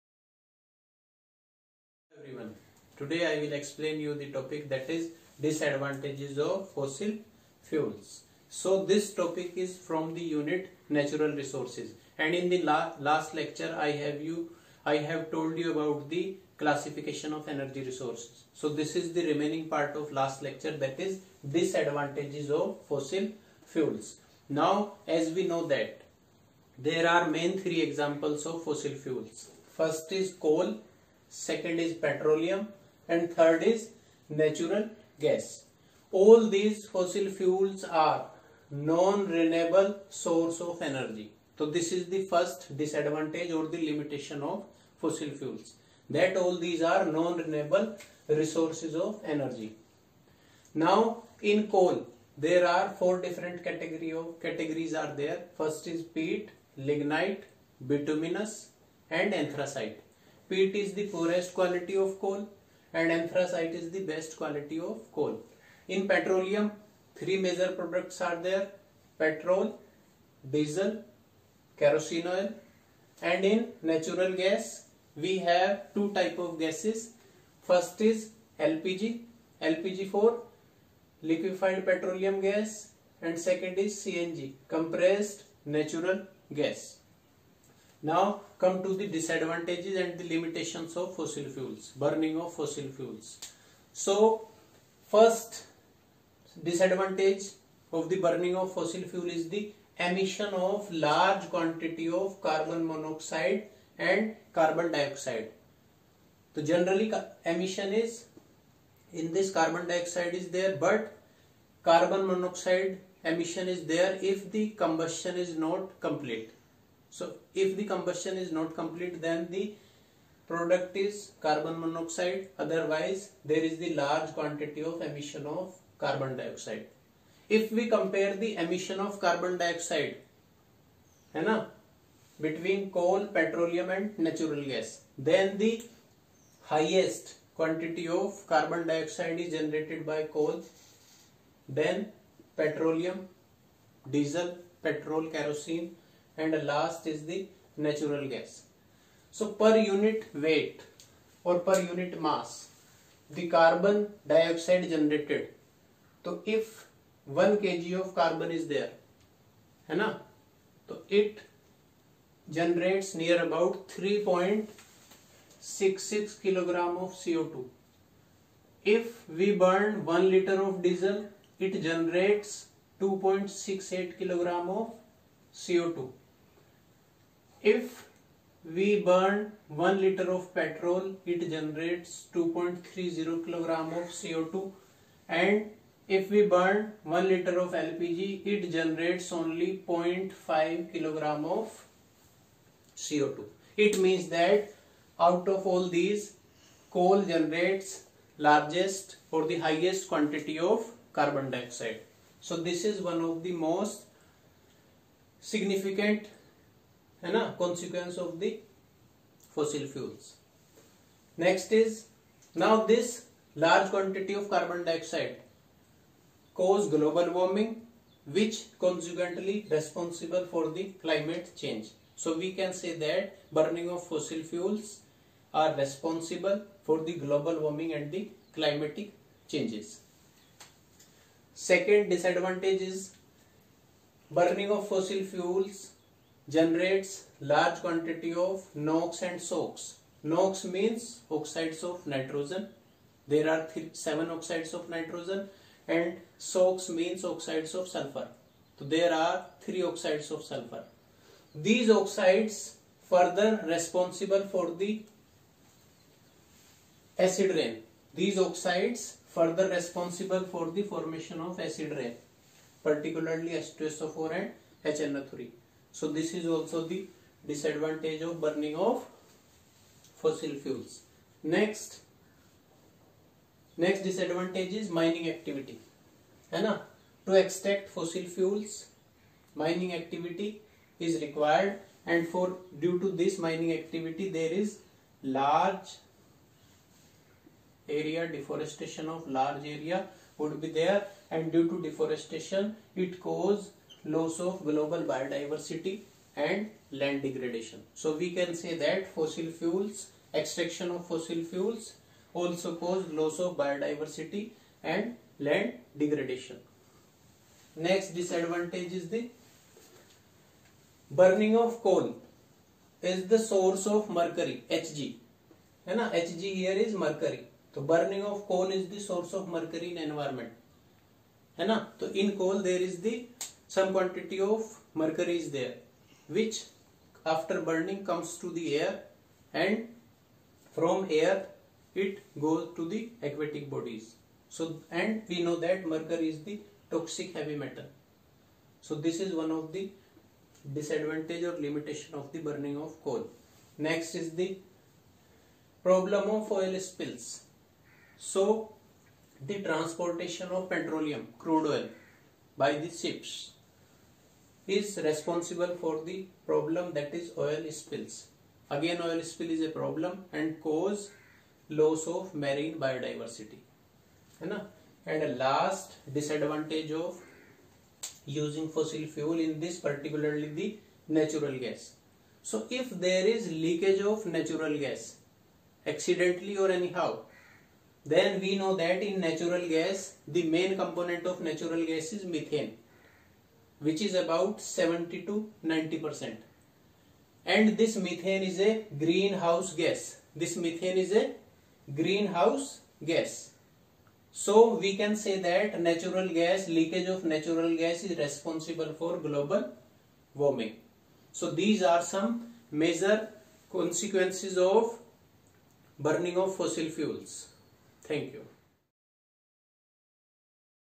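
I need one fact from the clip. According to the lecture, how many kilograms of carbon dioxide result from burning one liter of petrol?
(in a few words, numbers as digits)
2.30 kg.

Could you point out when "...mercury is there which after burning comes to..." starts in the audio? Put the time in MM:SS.
05:25.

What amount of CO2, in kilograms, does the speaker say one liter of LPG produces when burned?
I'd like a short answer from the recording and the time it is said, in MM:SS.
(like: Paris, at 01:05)
0.5 kg, at 03:09.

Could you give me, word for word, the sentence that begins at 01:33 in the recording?
So first disadvantage of the burning of fossil fuel is the emission of large quantity of carbon monoxide and carbon dioxide.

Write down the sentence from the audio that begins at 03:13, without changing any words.
It means that out of all these, coal generates largest or the highest quantity of carbon dioxide.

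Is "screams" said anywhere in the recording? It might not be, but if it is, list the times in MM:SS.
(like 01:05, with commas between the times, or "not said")
not said.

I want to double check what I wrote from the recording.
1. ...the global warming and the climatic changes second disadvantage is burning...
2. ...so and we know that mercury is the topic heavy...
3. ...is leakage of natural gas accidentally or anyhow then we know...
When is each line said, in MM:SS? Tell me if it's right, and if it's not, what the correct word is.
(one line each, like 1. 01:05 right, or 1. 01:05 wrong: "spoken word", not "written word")
1. 03:47 right
2. 05:34 wrong: "toxic", not "topic"
3. 06:13 right.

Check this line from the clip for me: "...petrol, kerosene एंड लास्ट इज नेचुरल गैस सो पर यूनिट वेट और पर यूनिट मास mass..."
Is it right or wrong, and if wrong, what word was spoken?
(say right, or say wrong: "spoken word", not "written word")
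right.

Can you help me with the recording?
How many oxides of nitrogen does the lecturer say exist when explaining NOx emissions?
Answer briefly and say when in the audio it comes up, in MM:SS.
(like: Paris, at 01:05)
7, at 04:03.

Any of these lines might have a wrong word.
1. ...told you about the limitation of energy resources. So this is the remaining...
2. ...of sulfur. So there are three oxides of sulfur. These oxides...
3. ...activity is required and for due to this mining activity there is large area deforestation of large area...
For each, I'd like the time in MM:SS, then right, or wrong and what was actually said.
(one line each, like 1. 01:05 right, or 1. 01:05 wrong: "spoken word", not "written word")
1. 00:15 wrong: "classification", not "limitation"
2. 04:07 right
3. 04:39 right.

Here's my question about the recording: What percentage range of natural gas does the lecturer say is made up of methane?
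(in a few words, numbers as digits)
70 to 90 percent.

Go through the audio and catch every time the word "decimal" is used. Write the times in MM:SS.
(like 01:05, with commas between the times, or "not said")
not said.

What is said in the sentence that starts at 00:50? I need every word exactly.
Now in coal there are four different category of, categories are there.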